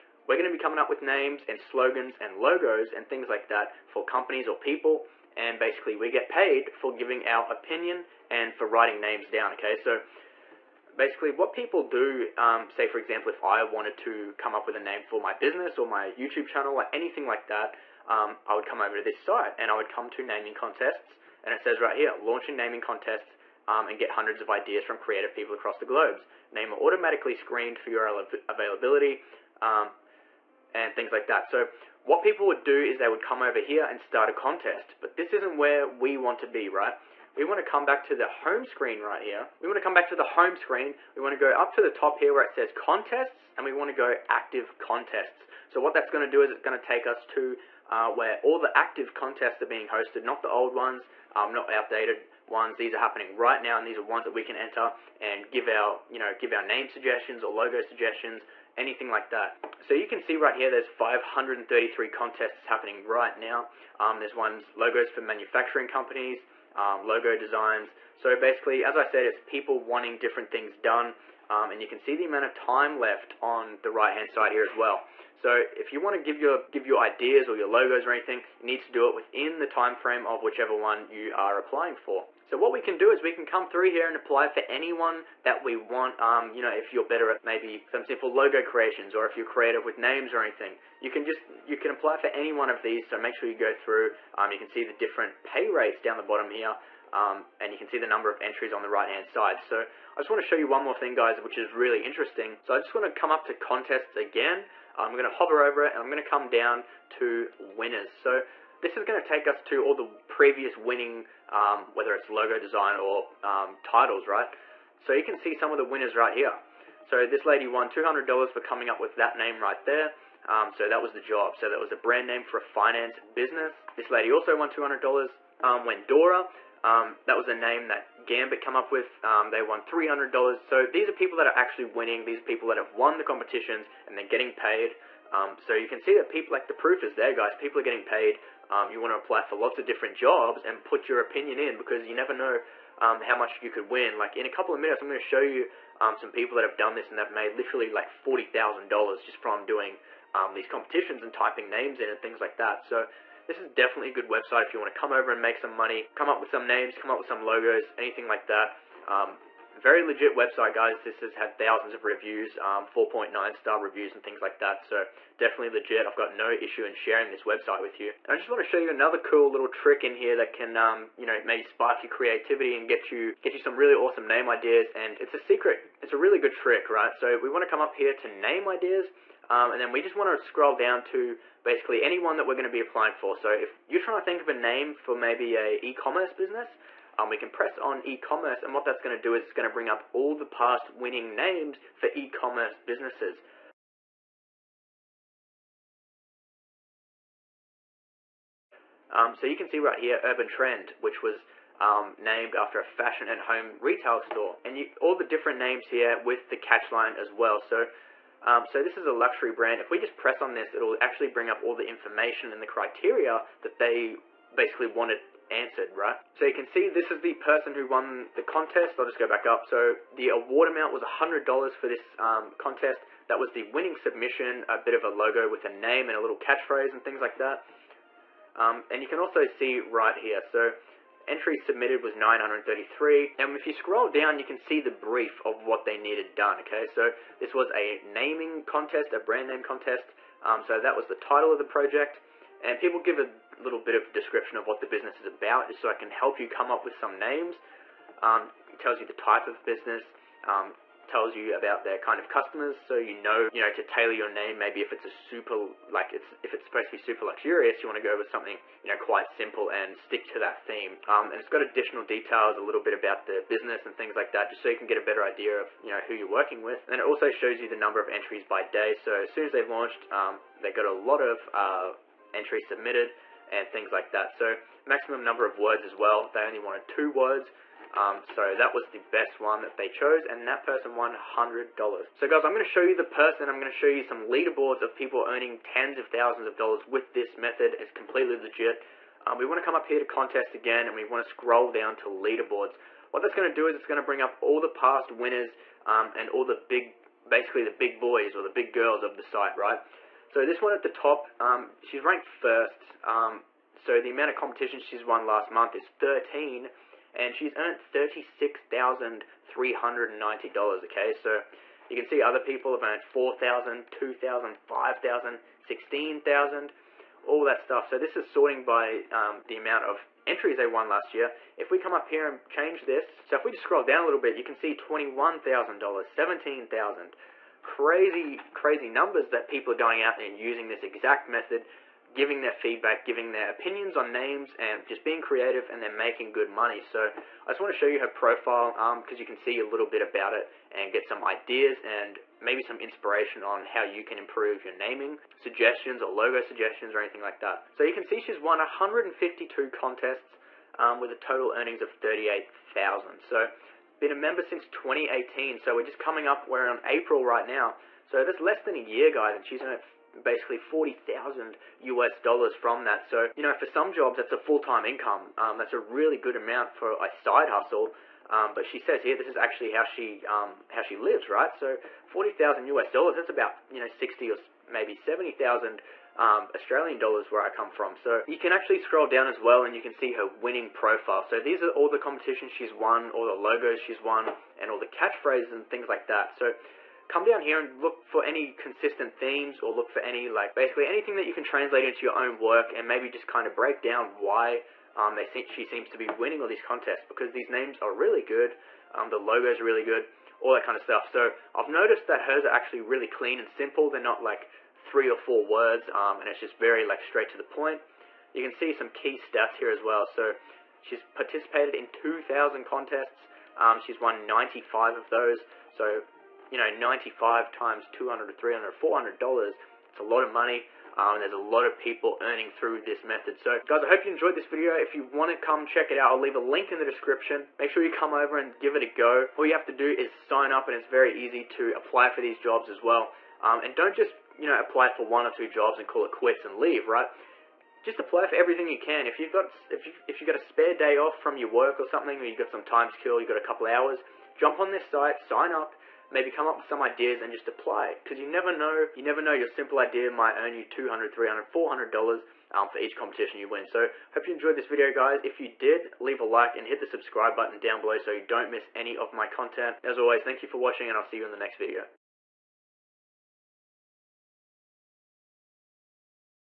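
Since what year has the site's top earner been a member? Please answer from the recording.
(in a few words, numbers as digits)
2018.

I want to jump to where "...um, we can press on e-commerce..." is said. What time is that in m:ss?
3:07.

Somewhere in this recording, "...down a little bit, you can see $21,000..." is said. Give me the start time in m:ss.
5:23.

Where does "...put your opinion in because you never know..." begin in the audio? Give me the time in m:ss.
2:20.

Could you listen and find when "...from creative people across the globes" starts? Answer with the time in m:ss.
0:24.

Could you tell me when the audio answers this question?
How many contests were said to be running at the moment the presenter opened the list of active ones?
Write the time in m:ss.
1:00.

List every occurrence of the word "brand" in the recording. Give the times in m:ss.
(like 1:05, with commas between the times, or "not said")
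2:01, 3:29, 3:59.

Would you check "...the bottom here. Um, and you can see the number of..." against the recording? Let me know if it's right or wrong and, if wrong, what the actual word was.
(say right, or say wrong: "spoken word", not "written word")
right.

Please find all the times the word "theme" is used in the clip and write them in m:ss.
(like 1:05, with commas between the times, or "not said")
4:20, 6:29.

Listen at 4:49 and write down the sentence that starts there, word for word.
Um, we want to come up here to contest again and we want to scroll down to leaderboards.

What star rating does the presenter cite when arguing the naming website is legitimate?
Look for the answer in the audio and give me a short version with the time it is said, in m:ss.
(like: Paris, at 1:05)
4.9, at 2:42.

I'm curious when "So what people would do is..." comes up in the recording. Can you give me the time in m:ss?
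0:31.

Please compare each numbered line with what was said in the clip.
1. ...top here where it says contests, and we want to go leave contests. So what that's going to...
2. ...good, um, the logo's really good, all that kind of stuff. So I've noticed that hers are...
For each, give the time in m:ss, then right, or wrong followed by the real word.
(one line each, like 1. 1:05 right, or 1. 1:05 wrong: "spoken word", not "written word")
1. 0:41 wrong: "active", not "leave"
2. 6:38 right.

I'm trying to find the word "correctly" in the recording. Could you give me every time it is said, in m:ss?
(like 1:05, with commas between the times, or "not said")
not said.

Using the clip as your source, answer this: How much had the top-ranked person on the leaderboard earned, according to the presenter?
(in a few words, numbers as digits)
$36,390.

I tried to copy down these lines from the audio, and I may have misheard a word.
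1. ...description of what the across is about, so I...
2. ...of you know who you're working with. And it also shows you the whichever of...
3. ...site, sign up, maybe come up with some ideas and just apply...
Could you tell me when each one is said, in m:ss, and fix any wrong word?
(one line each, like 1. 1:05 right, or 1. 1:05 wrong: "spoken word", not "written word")
1. 4:04 wrong: "business", not "across"
2. 4:25 wrong: "number", not "whichever"
3. 7:24 right.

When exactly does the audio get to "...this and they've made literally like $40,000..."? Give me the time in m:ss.
2:26.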